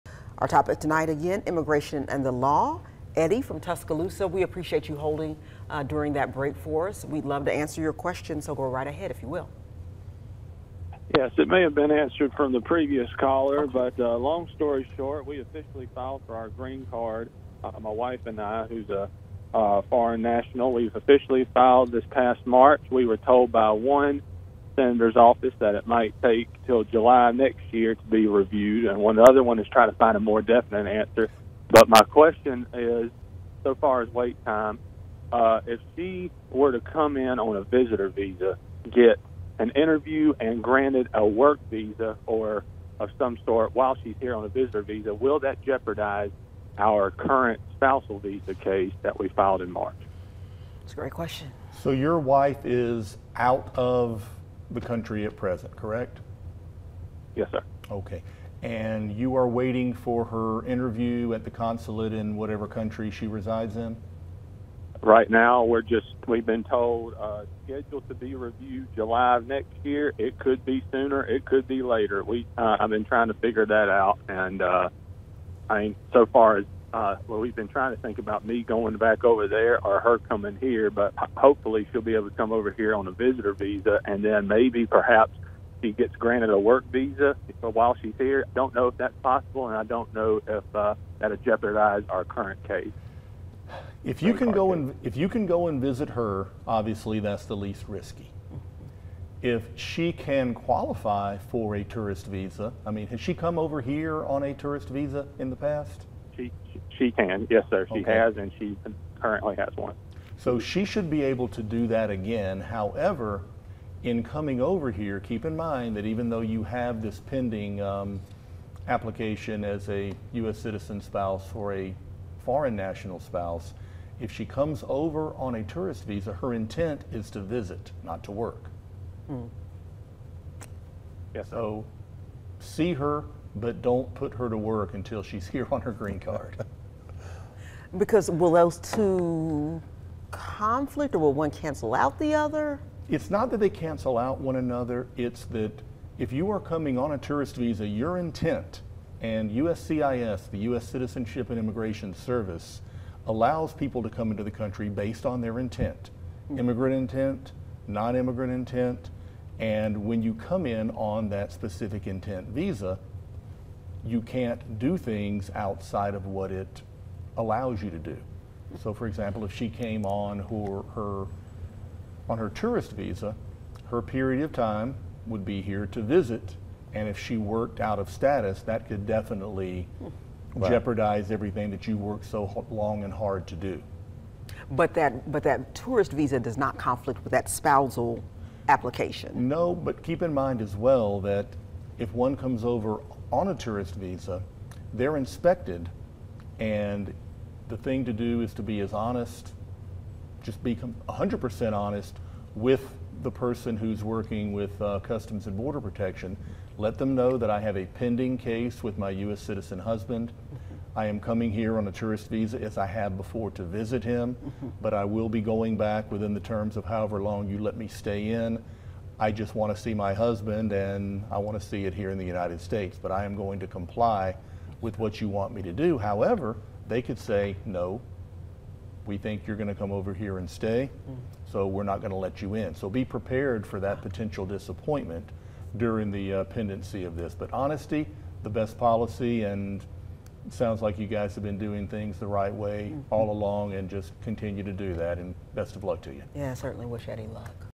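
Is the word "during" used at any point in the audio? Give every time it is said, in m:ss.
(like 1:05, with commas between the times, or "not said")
0:05, 3:55.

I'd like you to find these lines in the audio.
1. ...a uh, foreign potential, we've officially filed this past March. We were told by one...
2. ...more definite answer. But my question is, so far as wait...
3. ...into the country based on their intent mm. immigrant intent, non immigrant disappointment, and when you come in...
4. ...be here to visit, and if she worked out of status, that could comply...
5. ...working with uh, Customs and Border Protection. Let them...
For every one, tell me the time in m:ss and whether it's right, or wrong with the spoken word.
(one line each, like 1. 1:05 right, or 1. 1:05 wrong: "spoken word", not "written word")
1. 0:18 wrong: "national", not "potential"
2. 0:30 right
3. 2:34 wrong: "intent", not "disappointment"
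4. 2:55 wrong: "definitely", not "comply"
5. 3:24 right.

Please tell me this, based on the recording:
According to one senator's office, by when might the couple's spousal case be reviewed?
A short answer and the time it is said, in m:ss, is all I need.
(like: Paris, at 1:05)
July next year, at 0:26.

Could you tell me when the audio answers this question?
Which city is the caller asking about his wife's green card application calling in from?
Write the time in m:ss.
0:03.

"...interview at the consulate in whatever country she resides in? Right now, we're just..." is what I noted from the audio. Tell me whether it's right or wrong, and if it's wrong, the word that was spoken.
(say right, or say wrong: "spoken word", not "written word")
right.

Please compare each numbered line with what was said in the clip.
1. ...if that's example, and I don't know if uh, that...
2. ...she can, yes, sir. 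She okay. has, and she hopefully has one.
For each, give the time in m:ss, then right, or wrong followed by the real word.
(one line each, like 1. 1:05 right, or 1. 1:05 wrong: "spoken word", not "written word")
1. 1:28 wrong: "possible", not "example"
2. 1:46 wrong: "currently", not "hopefully".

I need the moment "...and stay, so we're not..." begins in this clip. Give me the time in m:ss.
3:50.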